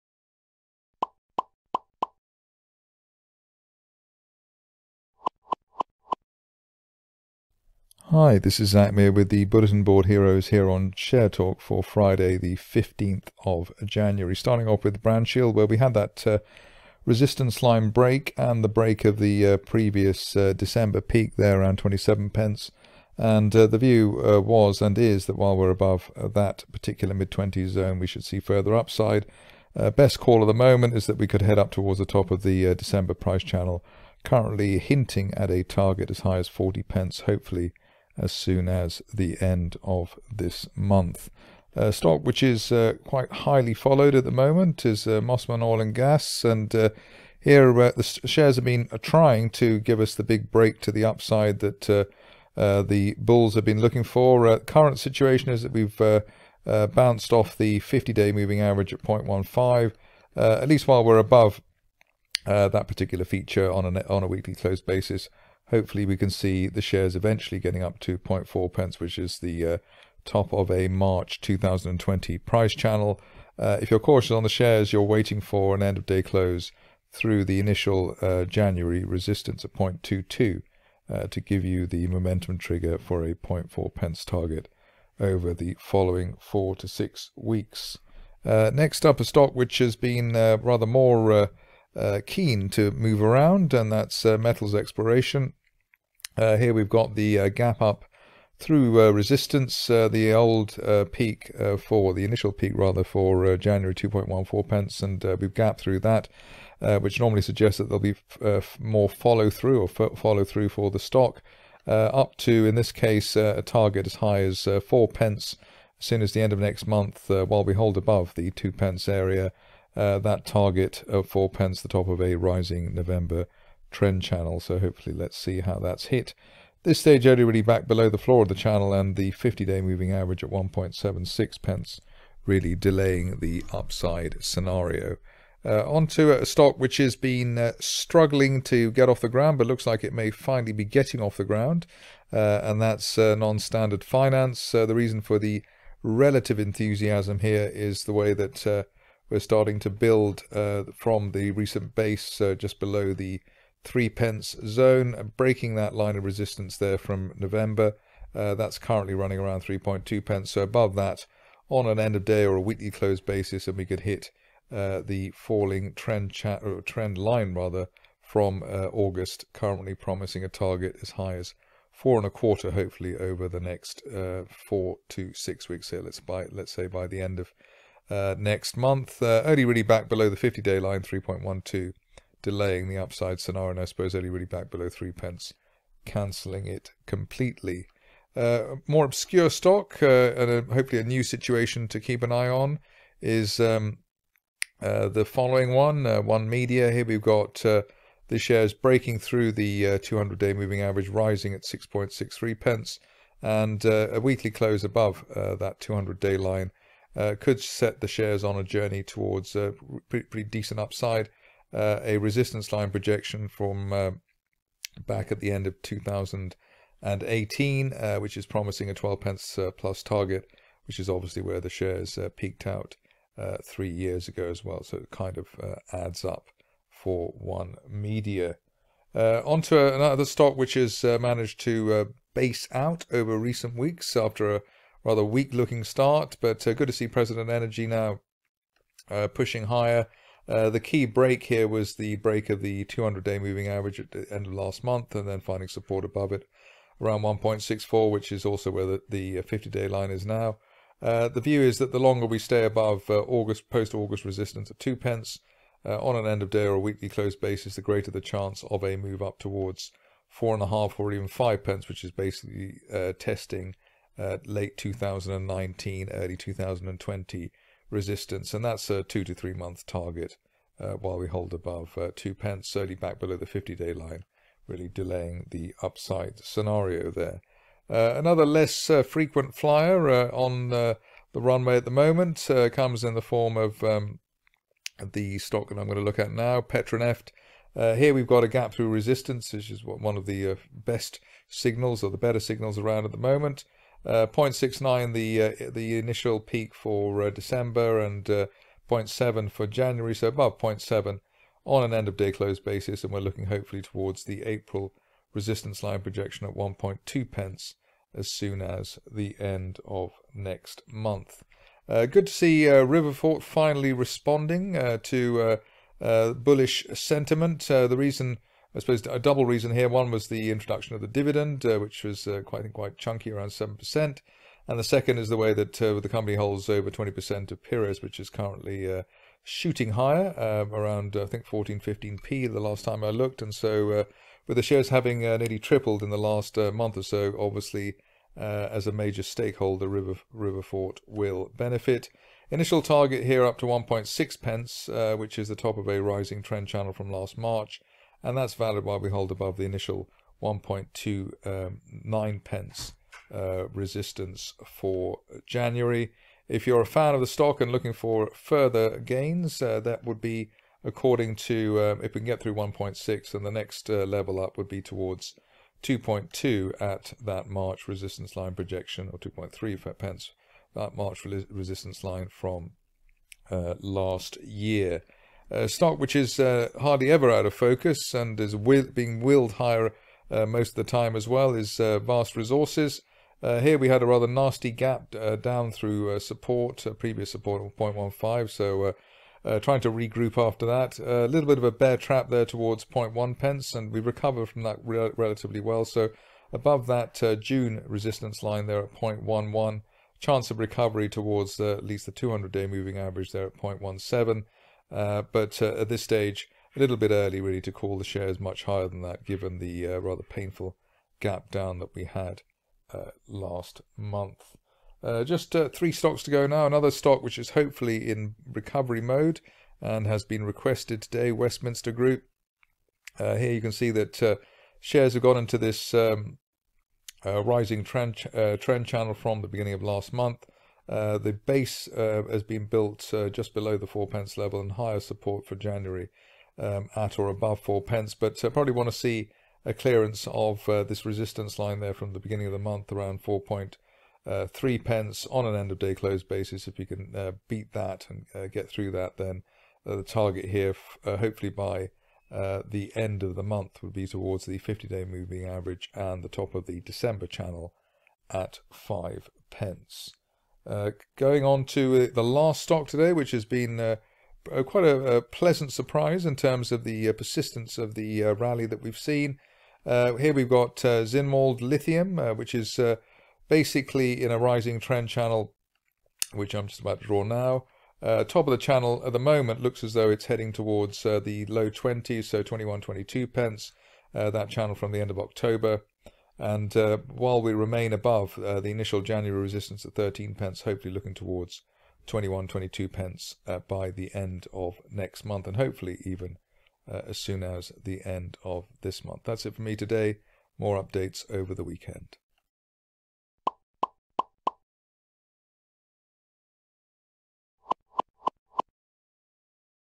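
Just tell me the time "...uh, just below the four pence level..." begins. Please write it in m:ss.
7:13.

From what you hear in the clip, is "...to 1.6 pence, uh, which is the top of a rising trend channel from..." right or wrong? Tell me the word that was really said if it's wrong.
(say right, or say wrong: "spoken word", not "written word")
right.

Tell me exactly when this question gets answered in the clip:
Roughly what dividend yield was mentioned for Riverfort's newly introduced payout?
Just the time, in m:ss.
5:23.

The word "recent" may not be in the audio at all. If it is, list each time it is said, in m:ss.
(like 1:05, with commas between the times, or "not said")
2:31, 3:53.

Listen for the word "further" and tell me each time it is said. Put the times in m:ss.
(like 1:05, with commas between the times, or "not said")
0:28, 5:58.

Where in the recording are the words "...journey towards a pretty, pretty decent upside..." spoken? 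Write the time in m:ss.
3:28.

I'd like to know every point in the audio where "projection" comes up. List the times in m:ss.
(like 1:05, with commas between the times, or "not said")
3:32, 5:06, 6:08.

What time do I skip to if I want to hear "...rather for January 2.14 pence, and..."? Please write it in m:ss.
1:42.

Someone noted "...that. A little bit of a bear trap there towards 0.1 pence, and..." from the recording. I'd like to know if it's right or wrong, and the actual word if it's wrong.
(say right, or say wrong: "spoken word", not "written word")
right.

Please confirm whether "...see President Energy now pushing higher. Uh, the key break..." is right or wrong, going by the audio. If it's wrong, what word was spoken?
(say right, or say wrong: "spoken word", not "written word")
right.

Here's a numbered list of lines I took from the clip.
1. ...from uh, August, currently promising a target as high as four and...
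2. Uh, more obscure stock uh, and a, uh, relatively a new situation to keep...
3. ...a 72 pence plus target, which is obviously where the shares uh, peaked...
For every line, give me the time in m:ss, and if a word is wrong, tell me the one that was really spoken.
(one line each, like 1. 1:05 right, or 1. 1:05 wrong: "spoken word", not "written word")
1. 2:48 right
2. 3:08 wrong: "hopefully", not "relatively"
3. 3:38 wrong: "12", not "72".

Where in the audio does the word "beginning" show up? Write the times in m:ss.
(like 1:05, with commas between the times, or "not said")
7:09, 7:22.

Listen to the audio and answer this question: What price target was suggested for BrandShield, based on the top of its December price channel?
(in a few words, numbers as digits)
40 pence.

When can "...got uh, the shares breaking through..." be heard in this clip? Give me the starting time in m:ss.
3:17.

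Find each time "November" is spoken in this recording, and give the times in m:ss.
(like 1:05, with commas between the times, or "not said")
2:02, 2:37.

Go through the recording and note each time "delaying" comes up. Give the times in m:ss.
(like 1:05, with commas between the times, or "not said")
2:12, 3:02, 4:34.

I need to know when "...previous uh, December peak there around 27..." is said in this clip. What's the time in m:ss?
0:19.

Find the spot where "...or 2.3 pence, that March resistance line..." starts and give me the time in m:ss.
6:09.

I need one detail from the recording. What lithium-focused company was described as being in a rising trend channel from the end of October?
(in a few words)
Zinnwald Lithium.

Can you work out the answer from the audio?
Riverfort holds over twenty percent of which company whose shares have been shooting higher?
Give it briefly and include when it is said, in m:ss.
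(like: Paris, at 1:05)
Pires, at 5:27.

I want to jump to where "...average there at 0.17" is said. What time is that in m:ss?
6:42.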